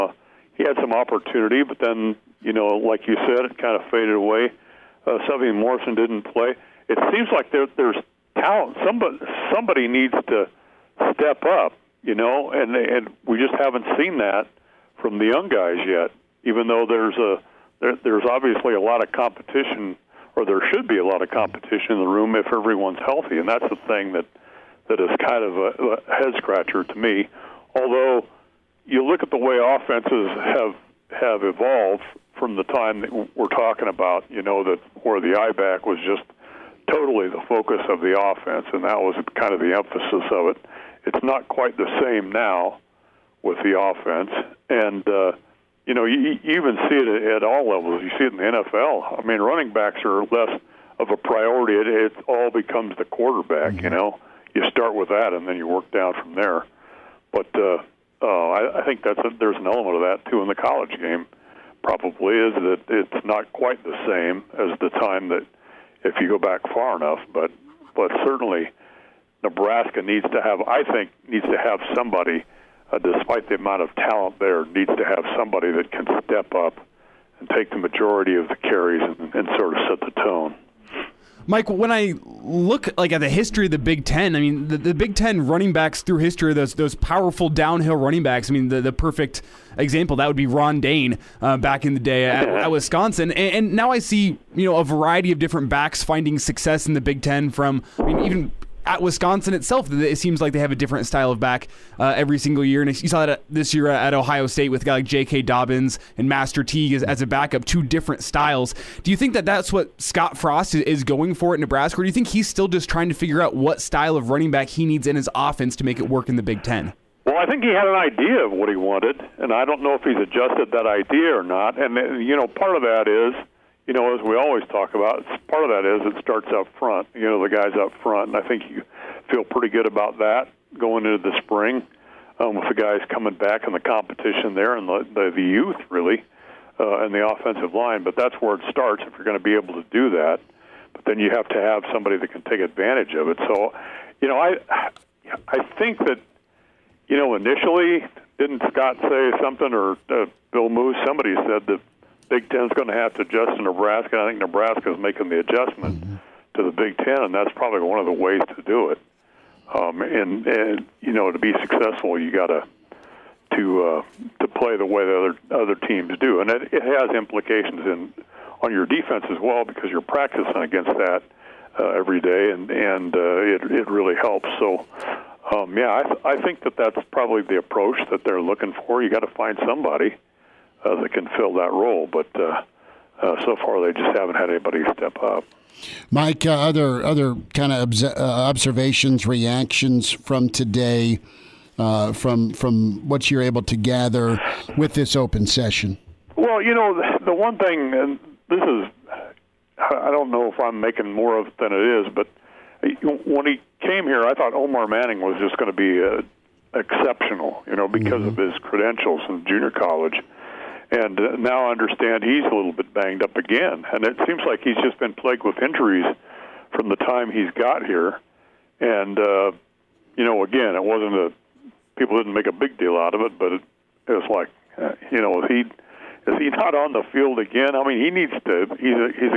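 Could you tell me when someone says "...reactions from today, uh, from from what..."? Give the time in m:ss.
3:09.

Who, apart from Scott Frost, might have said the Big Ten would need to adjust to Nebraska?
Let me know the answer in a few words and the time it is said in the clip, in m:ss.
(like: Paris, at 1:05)
Bill Moos, at 2:30.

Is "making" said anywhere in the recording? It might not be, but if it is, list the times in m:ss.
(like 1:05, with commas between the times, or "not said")
2:34, 3:20.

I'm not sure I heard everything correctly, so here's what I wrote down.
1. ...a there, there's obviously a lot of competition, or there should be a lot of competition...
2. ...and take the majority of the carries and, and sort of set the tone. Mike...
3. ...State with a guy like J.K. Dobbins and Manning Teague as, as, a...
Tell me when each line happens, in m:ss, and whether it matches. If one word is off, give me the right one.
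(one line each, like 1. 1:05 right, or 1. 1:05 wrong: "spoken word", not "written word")
1. 0:17 right
2. 1:17 right
3. 1:44 wrong: "Master", not "Manning".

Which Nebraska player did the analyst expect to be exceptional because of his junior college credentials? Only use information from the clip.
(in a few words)
Omar Manning.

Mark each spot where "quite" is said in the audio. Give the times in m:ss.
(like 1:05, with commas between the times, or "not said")
0:41, 1:03.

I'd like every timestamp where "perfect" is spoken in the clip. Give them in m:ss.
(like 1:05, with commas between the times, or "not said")
1:28.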